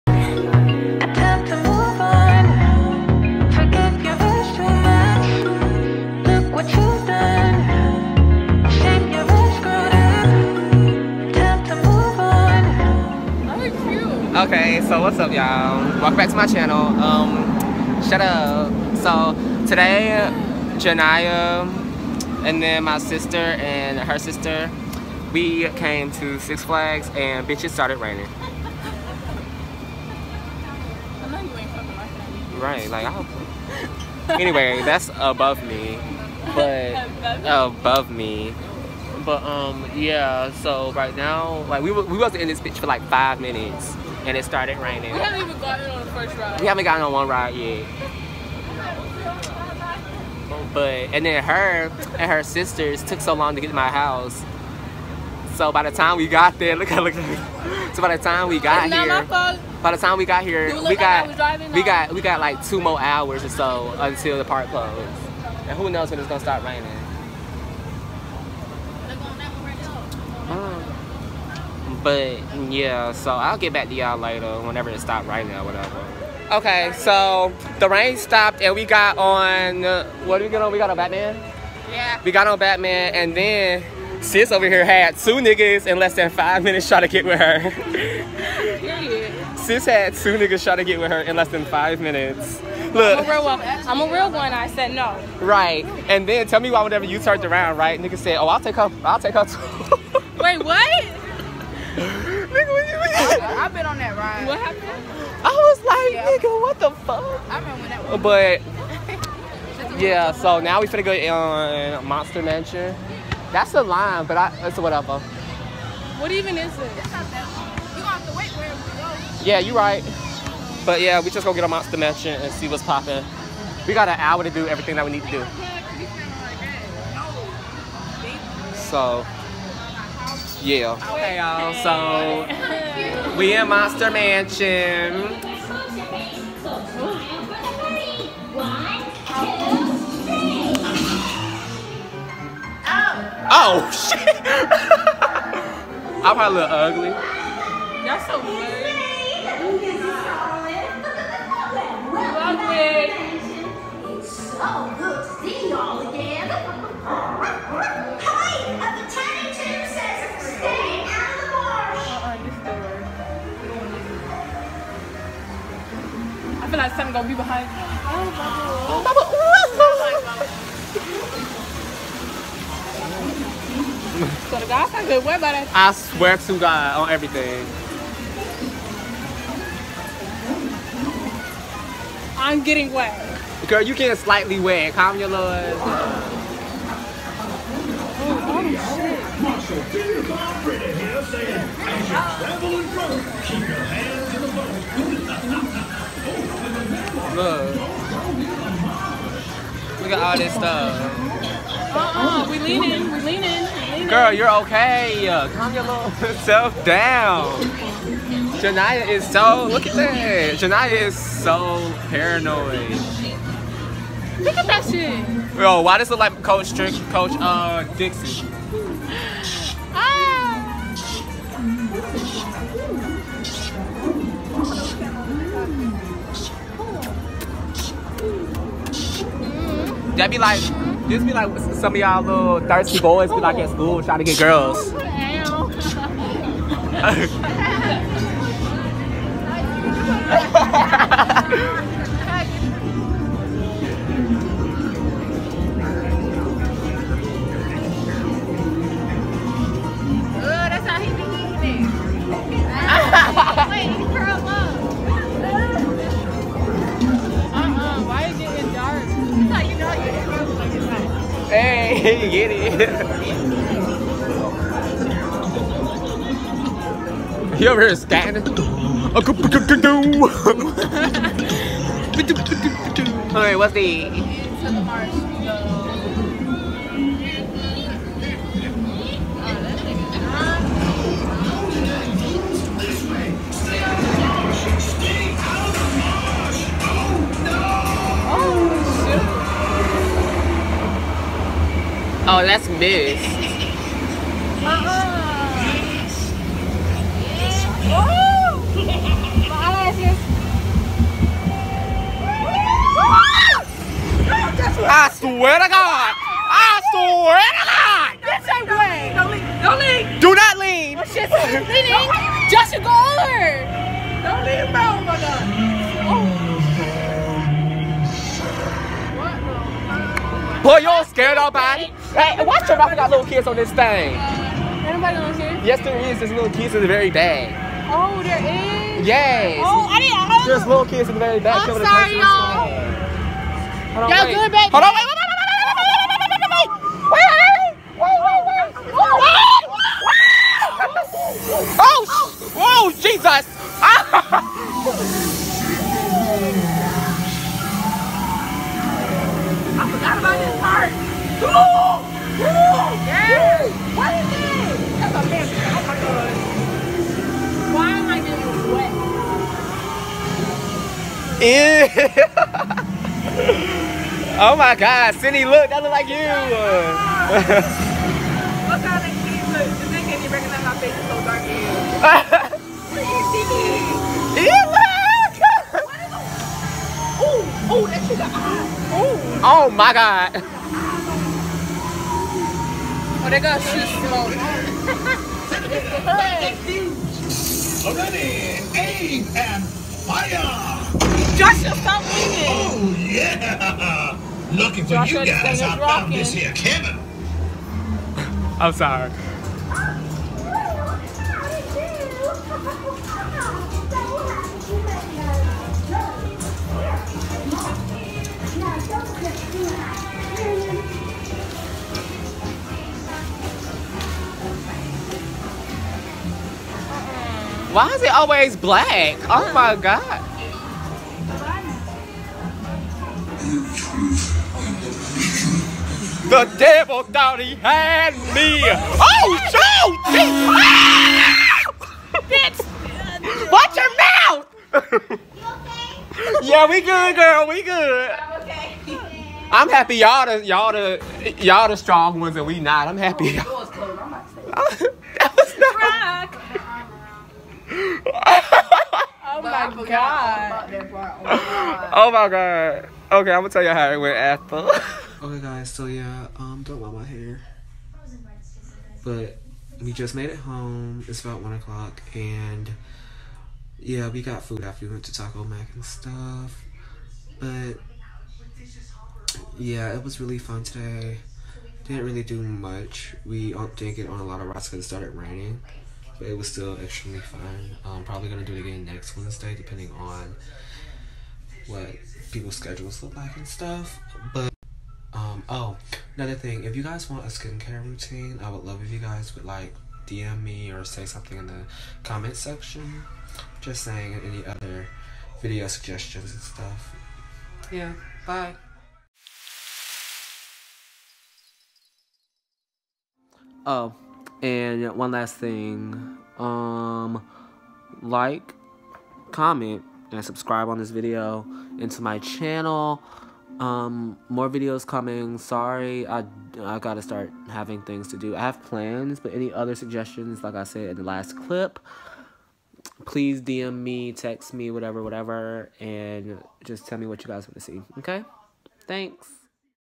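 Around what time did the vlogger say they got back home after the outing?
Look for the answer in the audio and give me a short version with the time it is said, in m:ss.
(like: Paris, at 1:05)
1 o'clock, at 7:41.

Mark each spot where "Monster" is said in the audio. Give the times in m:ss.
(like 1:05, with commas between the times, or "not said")
1:52, 2:01, 2:13.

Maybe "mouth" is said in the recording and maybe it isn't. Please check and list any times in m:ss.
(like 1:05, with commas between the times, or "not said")
5:22, 7:14.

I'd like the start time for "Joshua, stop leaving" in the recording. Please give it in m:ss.
6:31.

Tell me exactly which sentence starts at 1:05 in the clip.
And who knows when it's gonna start raining.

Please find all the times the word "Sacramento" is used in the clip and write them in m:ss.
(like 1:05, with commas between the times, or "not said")
not said.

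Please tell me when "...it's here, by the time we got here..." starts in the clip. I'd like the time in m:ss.
0:58.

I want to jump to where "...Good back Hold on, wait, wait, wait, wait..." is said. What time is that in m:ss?
5:34.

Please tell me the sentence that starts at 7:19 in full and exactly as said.
I'm happy y'all the y'all the y'all the strong ones and we not.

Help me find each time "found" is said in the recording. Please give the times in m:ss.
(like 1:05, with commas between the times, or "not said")
6:35.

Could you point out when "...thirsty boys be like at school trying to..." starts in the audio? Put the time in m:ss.
3:52.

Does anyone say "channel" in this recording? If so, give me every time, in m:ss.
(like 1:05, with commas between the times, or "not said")
0:16, 8:32.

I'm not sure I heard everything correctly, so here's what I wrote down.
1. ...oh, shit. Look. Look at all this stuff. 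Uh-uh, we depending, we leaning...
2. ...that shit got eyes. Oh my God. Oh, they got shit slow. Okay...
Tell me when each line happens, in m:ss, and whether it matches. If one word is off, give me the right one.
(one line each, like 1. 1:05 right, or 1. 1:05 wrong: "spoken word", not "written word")
1. 3:13 wrong: "leaning", not "depending"
2. 6:17 right.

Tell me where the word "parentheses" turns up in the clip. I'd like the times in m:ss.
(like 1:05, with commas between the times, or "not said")
not said.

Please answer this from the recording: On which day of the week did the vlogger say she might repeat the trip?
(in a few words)
Wednesday.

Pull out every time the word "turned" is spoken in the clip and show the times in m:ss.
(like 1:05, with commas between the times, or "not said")
1:37.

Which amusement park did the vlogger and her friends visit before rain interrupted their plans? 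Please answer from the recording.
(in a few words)
Six Flags.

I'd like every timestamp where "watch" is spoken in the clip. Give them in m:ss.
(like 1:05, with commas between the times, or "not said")
5:22, 7:13.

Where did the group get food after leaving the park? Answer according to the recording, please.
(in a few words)
Taco Mac.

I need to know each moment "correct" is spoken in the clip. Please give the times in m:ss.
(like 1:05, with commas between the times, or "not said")
not said.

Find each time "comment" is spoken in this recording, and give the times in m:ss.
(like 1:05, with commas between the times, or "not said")
8:12, 8:29.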